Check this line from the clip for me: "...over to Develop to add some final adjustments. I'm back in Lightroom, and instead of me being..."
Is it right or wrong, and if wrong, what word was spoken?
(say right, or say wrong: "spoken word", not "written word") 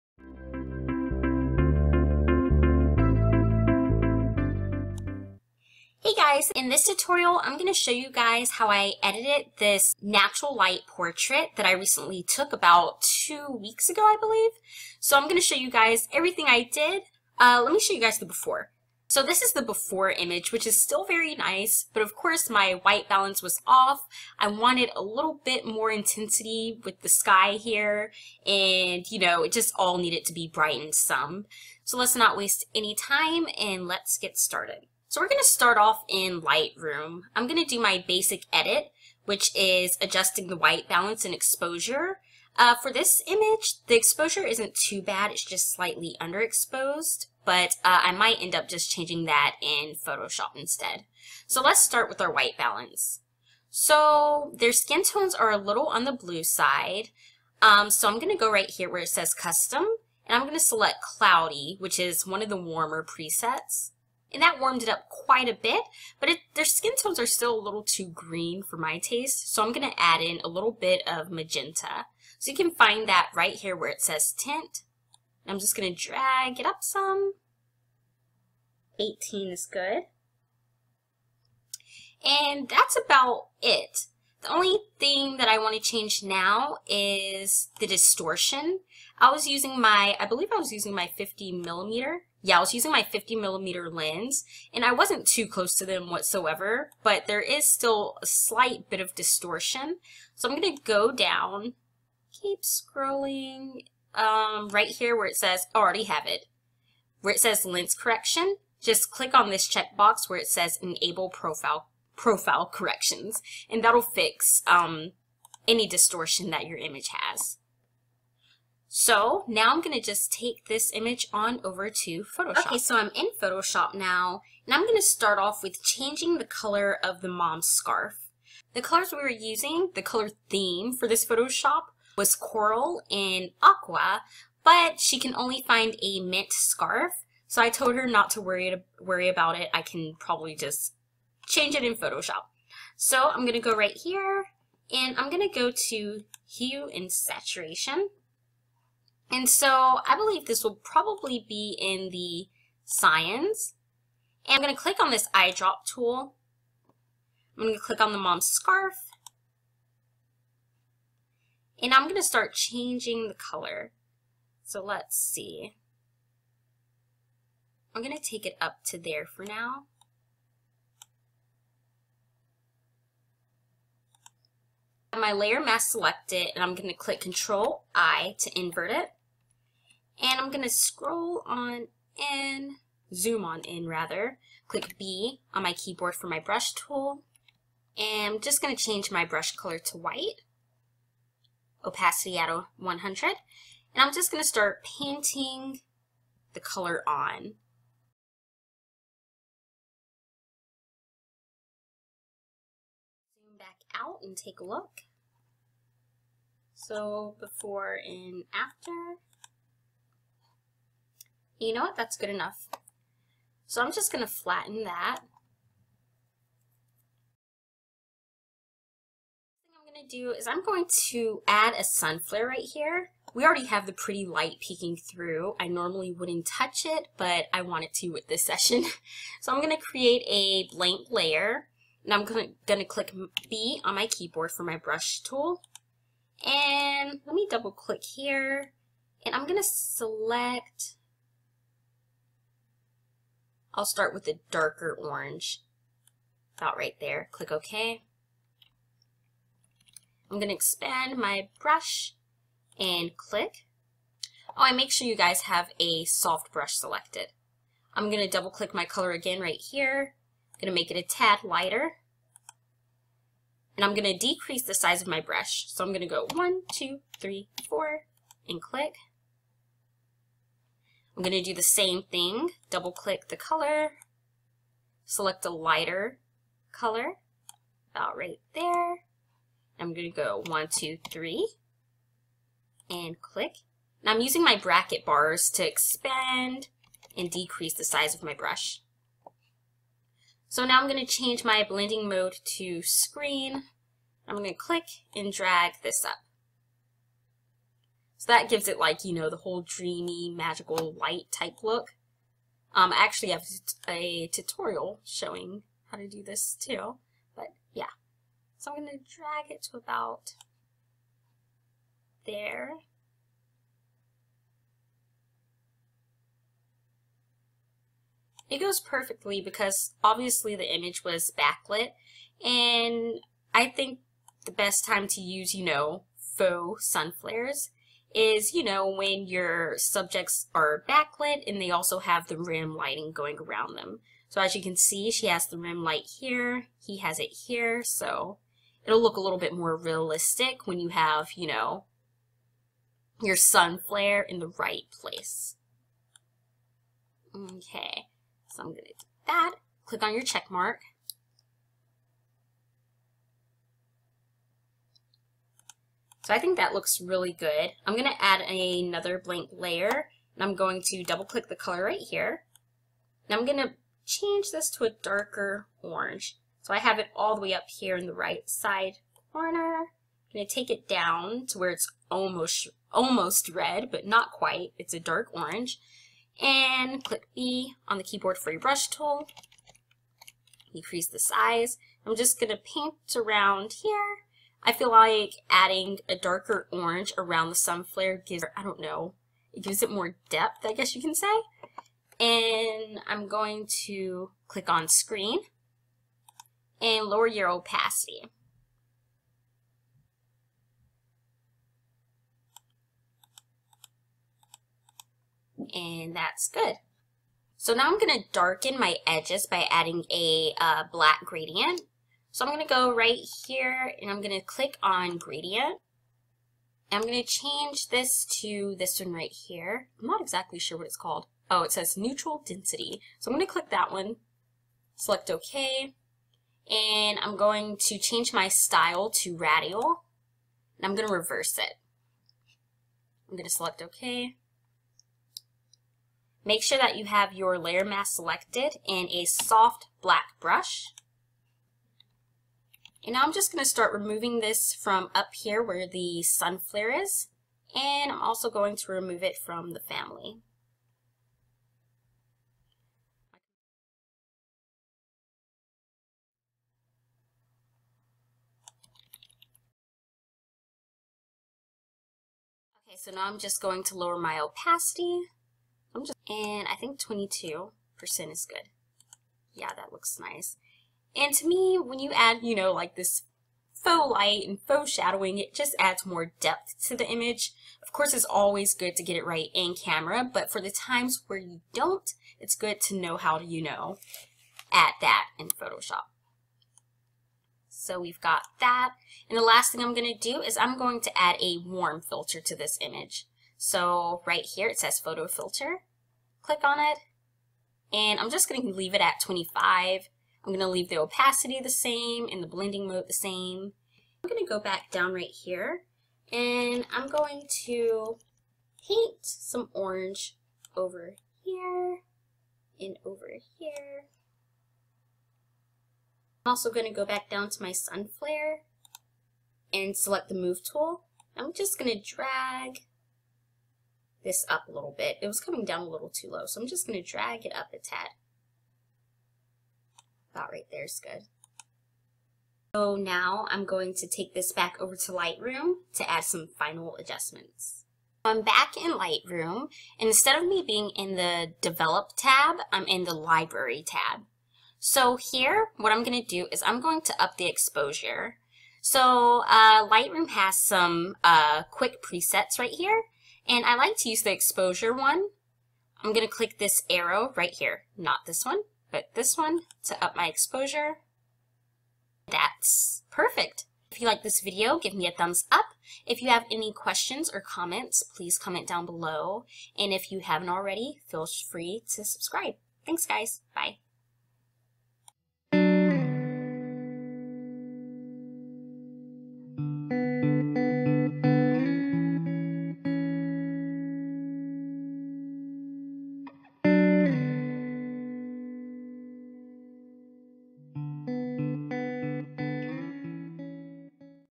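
wrong: "Lightroom", not "Develop".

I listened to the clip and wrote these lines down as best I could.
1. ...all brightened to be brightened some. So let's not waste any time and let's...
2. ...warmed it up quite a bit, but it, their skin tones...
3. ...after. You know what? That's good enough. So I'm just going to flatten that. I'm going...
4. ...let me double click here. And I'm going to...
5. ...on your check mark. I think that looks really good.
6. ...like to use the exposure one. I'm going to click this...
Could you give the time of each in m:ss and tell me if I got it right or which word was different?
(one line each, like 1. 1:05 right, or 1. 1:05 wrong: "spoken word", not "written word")
1. 0:29 wrong: "needed", not "brightened"
2. 1:04 right
3. 3:28 right
4. 3:57 right
5. 5:50 right
6. 9:13 right.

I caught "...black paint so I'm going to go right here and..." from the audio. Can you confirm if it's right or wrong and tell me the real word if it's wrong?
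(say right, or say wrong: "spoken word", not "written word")
wrong: "gradient", not "paint".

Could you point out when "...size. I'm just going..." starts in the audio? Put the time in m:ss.
6:21.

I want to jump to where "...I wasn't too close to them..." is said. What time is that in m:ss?
1:34.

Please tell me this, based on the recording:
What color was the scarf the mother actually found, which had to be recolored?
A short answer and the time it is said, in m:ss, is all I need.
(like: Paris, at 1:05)
Mint, at 2:16.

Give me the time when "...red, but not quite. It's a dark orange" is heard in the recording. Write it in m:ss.
6:13.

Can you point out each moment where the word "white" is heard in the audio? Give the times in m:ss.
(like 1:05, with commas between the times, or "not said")
0:22, 0:40, 0:52, 3:09.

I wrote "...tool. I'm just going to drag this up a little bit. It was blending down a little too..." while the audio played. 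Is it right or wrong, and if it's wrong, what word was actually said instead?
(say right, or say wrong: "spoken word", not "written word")
wrong: "coming", not "blending".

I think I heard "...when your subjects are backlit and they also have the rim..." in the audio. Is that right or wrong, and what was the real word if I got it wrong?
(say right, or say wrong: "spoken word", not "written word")
right.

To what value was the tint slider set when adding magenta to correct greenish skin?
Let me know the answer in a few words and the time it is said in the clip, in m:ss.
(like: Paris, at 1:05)
18, at 1:18.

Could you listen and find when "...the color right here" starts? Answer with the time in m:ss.
6:01.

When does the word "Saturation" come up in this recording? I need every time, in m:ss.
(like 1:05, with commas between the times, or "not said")
2:27.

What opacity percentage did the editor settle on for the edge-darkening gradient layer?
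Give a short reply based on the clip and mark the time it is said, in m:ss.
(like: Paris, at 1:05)
22%, at 7:46.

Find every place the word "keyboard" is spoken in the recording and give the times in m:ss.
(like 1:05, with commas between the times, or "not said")
3:05, 3:54, 6:18.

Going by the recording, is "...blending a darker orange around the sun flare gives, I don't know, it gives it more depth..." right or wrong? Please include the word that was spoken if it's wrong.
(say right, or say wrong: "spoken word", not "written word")
wrong: "adding", not "blending".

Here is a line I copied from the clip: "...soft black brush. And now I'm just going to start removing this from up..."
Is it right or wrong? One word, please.
right.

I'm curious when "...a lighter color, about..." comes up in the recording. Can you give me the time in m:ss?
4:35.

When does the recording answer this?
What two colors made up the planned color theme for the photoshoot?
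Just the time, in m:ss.
2:12.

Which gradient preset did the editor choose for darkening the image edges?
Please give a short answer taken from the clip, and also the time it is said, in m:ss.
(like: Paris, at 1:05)
Neutral density, at 7:01.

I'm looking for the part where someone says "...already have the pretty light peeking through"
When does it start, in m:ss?
3:43.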